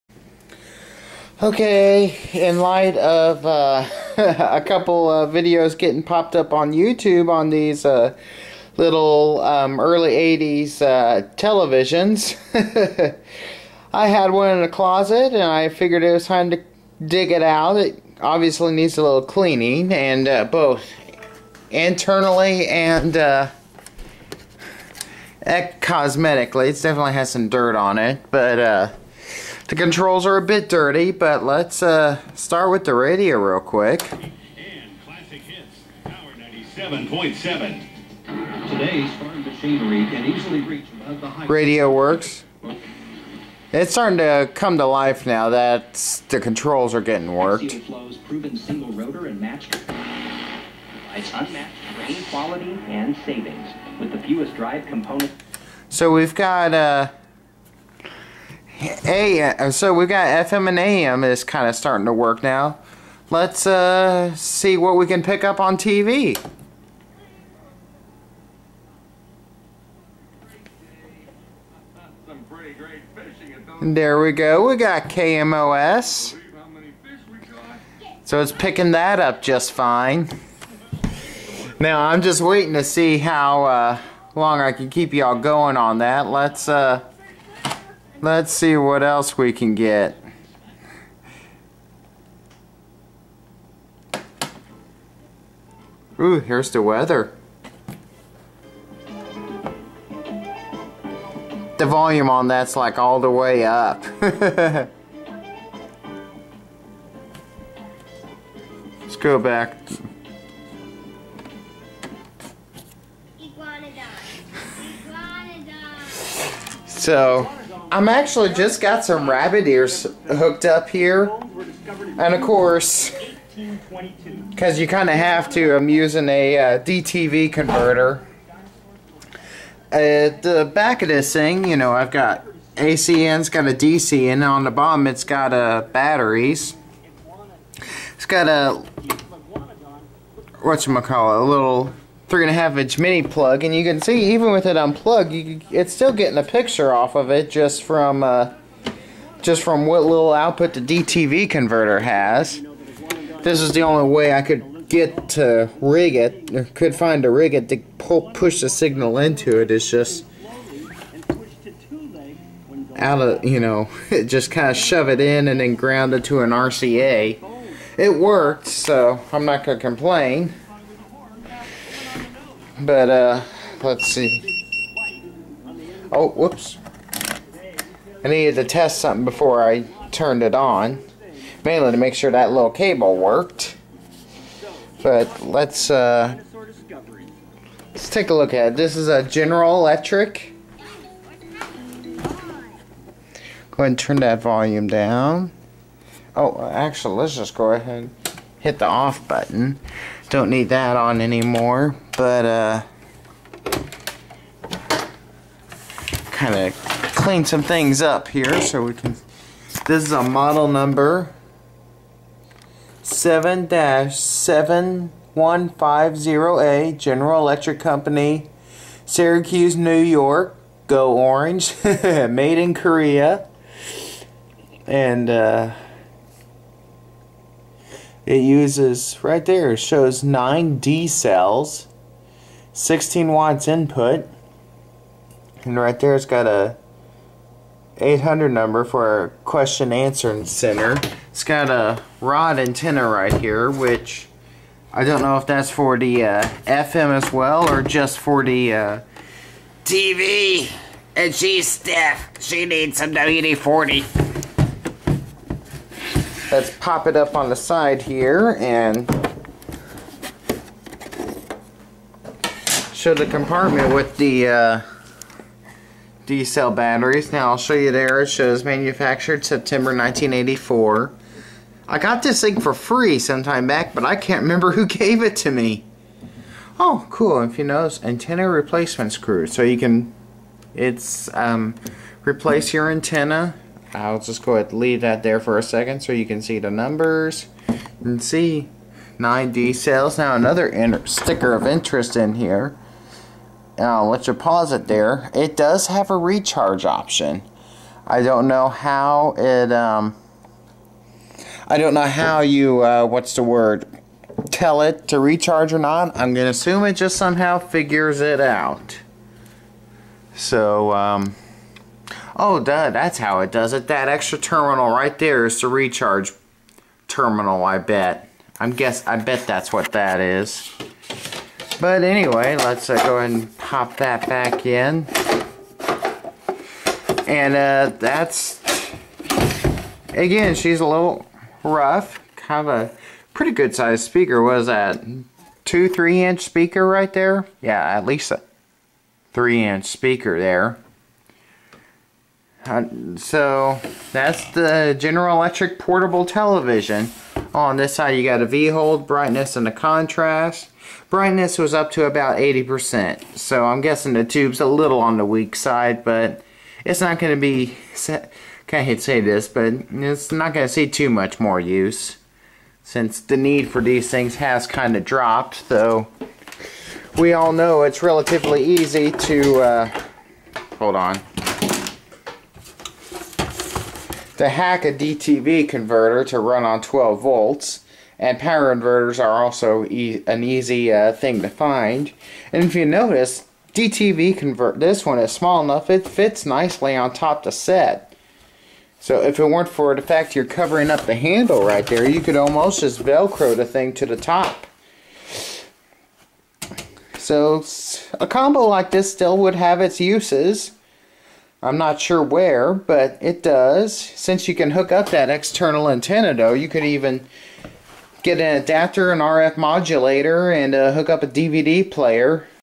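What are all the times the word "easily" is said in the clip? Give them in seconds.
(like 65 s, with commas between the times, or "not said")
40 s.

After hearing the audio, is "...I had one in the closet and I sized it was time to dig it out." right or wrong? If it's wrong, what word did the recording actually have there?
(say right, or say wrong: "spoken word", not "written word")
wrong: "figured", not "sized".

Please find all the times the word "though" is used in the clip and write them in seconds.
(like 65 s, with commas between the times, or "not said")
365 s, 406 s.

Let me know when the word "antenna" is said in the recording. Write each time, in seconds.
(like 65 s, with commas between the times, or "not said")
242 s, 278 s, 282 s, 405 s.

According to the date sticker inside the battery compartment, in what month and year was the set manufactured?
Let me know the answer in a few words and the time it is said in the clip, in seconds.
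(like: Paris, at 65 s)
September 1984, at 269 s.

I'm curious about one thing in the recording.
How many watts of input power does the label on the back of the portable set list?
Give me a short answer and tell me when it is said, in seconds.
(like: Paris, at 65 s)
16 watts, at 232 s.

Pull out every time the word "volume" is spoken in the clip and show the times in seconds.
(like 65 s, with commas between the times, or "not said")
101 s, 194 s.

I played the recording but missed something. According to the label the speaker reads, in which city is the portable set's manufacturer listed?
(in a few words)
Syracuse, New York.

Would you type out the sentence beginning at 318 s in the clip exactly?
I'm guess I bet that's what that is.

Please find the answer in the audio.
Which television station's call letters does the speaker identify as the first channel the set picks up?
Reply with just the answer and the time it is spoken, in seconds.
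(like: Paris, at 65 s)
KMOS, at 75 s.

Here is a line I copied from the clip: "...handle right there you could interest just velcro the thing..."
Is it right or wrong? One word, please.
wrong.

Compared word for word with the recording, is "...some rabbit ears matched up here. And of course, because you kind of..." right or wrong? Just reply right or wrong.
wrong.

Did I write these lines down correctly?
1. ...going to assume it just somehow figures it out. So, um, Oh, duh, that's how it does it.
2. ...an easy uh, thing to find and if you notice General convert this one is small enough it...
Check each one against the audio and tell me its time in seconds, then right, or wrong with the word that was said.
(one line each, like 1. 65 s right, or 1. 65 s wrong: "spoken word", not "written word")
1. 306 s right
2. 380 s wrong: "DTV", not "General".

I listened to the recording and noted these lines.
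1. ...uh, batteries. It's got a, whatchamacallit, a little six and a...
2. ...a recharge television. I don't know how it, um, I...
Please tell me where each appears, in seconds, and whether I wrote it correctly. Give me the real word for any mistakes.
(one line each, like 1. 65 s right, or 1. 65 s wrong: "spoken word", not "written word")
1. 135 s wrong: "three", not "six"
2. 296 s wrong: "option", not "television".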